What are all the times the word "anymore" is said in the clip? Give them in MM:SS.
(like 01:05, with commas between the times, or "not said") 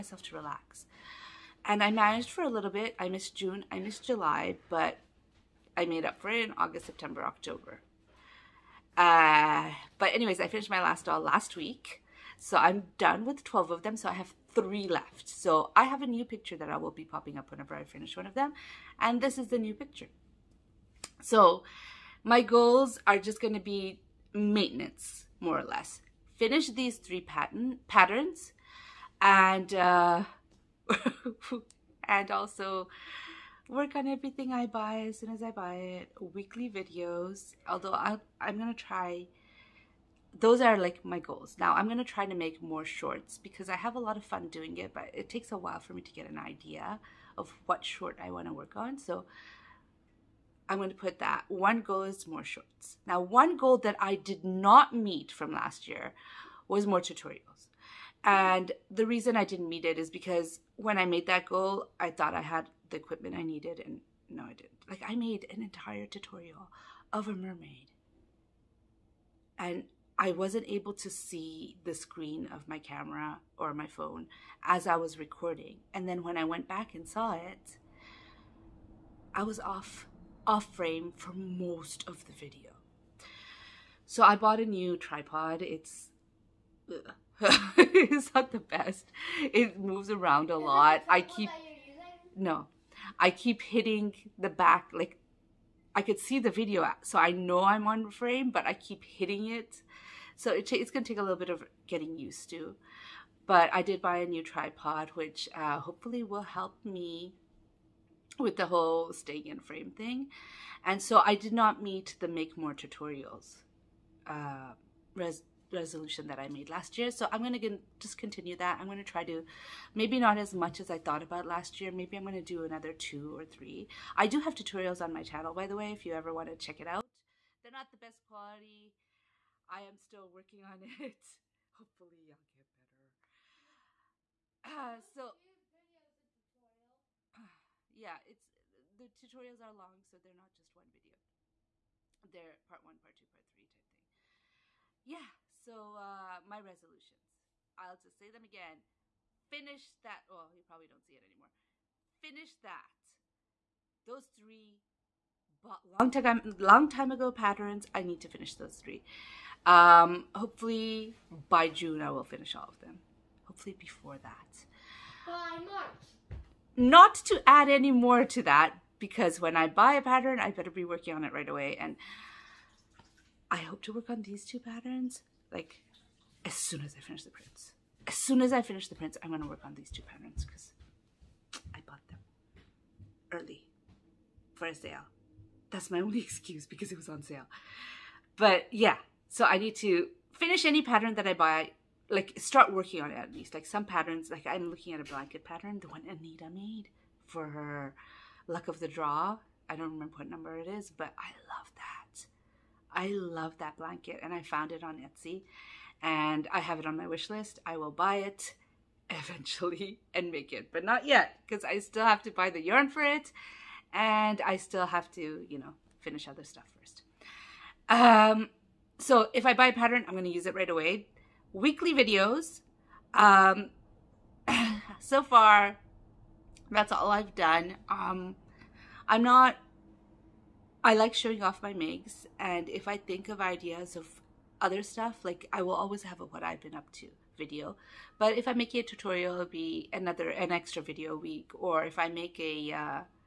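02:31.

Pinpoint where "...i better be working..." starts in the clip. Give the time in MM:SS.
02:50.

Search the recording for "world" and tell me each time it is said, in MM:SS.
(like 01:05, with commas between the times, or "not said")
not said.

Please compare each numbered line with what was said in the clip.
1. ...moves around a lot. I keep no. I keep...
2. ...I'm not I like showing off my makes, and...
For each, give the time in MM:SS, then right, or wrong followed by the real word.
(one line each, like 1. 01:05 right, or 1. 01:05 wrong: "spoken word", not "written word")
1. 01:29 right
2. 03:49 right.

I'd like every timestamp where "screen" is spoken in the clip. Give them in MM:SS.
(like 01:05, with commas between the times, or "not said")
01:11.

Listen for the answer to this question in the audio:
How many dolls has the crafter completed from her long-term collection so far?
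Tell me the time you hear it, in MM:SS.
00:13.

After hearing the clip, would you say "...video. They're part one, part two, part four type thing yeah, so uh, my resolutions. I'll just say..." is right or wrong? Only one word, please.
wrong.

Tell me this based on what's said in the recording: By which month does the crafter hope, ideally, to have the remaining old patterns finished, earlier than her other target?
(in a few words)
March.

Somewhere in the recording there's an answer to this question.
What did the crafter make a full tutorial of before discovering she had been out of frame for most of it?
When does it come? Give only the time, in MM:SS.
01:07.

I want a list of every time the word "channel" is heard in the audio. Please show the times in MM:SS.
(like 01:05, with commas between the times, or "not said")
02:05.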